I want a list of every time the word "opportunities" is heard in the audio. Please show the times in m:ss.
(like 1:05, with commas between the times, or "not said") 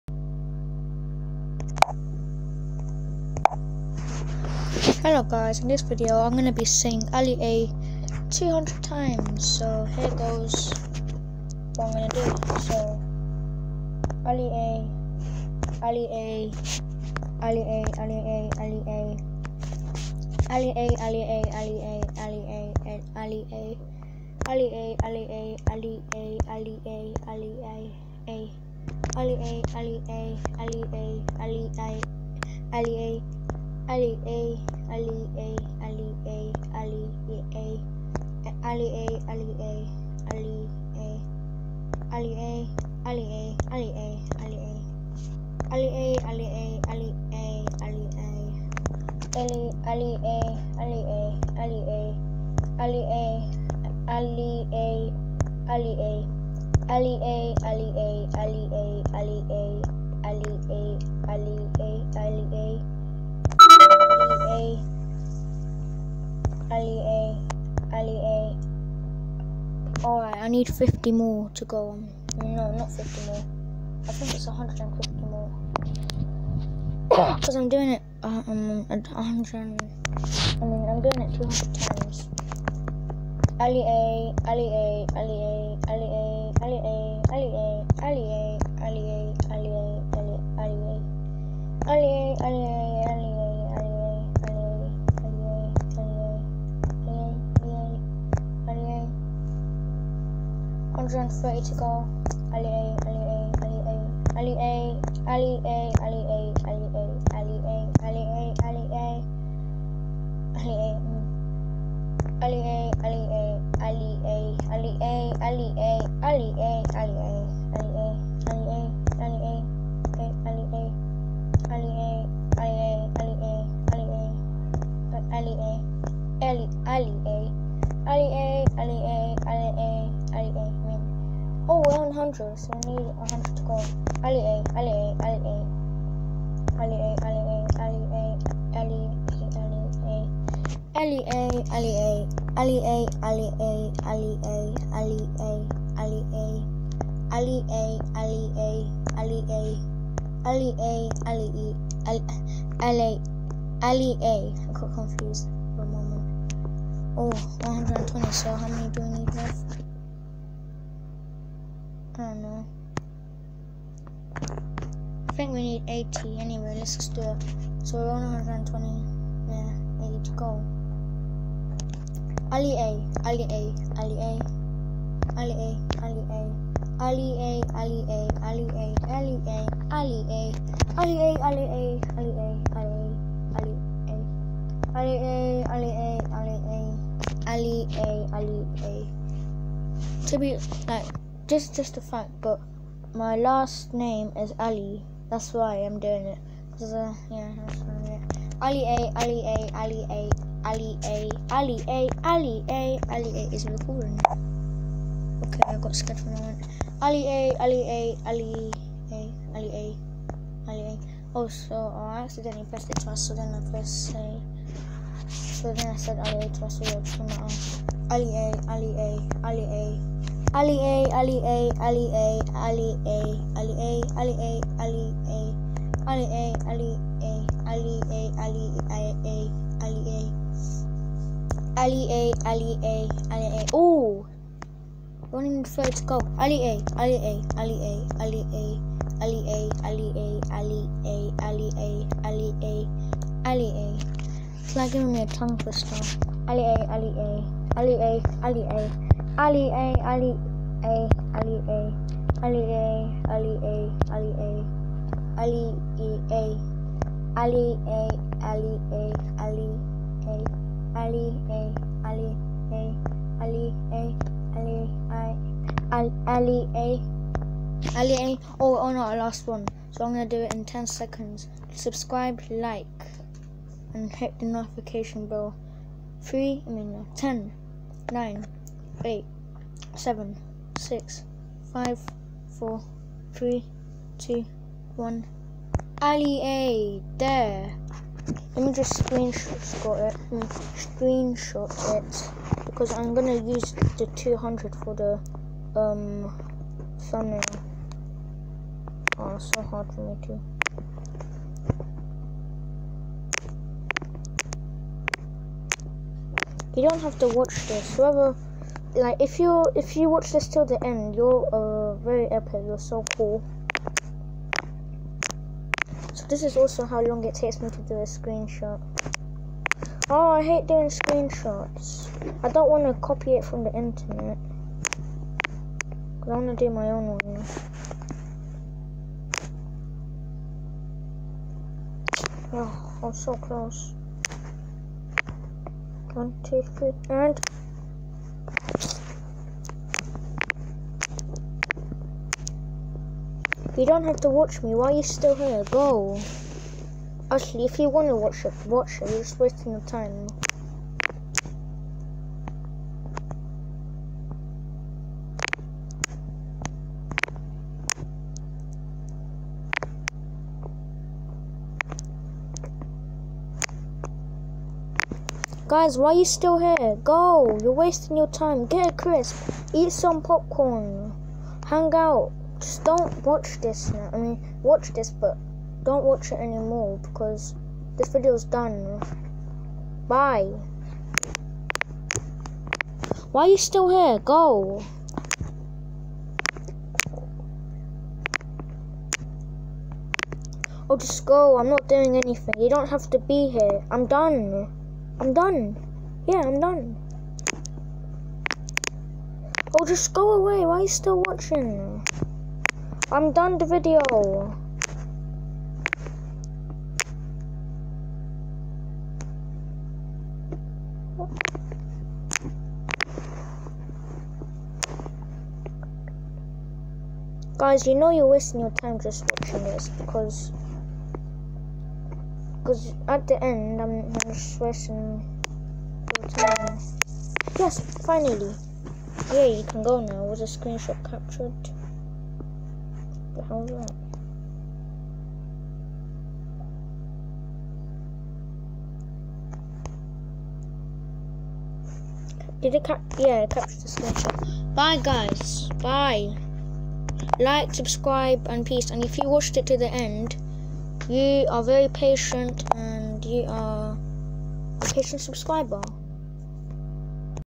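not said.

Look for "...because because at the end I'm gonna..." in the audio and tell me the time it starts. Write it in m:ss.
6:59.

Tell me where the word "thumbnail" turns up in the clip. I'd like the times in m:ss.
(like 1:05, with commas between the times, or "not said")
4:56.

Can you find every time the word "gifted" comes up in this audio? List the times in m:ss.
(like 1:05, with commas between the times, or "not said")
not said.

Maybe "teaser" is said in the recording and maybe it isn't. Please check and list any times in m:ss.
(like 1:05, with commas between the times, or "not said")
not said.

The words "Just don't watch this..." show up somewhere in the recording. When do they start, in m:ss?
6:12.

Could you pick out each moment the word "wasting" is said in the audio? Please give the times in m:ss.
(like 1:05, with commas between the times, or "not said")
5:49, 6:07, 6:58.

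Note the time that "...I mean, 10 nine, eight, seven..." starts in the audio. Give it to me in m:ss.
4:36.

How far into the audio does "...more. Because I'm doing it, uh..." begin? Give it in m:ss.
1:15.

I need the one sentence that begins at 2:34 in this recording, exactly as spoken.
I got confused for a moment.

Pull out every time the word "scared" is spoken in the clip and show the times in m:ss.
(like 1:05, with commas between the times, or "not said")
3:25.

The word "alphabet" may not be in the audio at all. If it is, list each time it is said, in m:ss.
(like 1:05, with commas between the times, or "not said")
not said.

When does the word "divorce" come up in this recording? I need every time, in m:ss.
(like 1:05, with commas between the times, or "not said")
not said.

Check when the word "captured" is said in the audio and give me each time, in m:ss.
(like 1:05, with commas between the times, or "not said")
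7:11, 7:23.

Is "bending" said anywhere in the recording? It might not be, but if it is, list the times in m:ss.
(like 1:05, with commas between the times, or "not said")
not said.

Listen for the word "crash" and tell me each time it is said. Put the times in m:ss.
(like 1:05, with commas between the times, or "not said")
not said.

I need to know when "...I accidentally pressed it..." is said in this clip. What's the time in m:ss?
3:31.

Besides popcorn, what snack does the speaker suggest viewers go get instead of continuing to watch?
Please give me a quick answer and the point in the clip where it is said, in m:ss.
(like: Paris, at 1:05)
crisp, at 6:08.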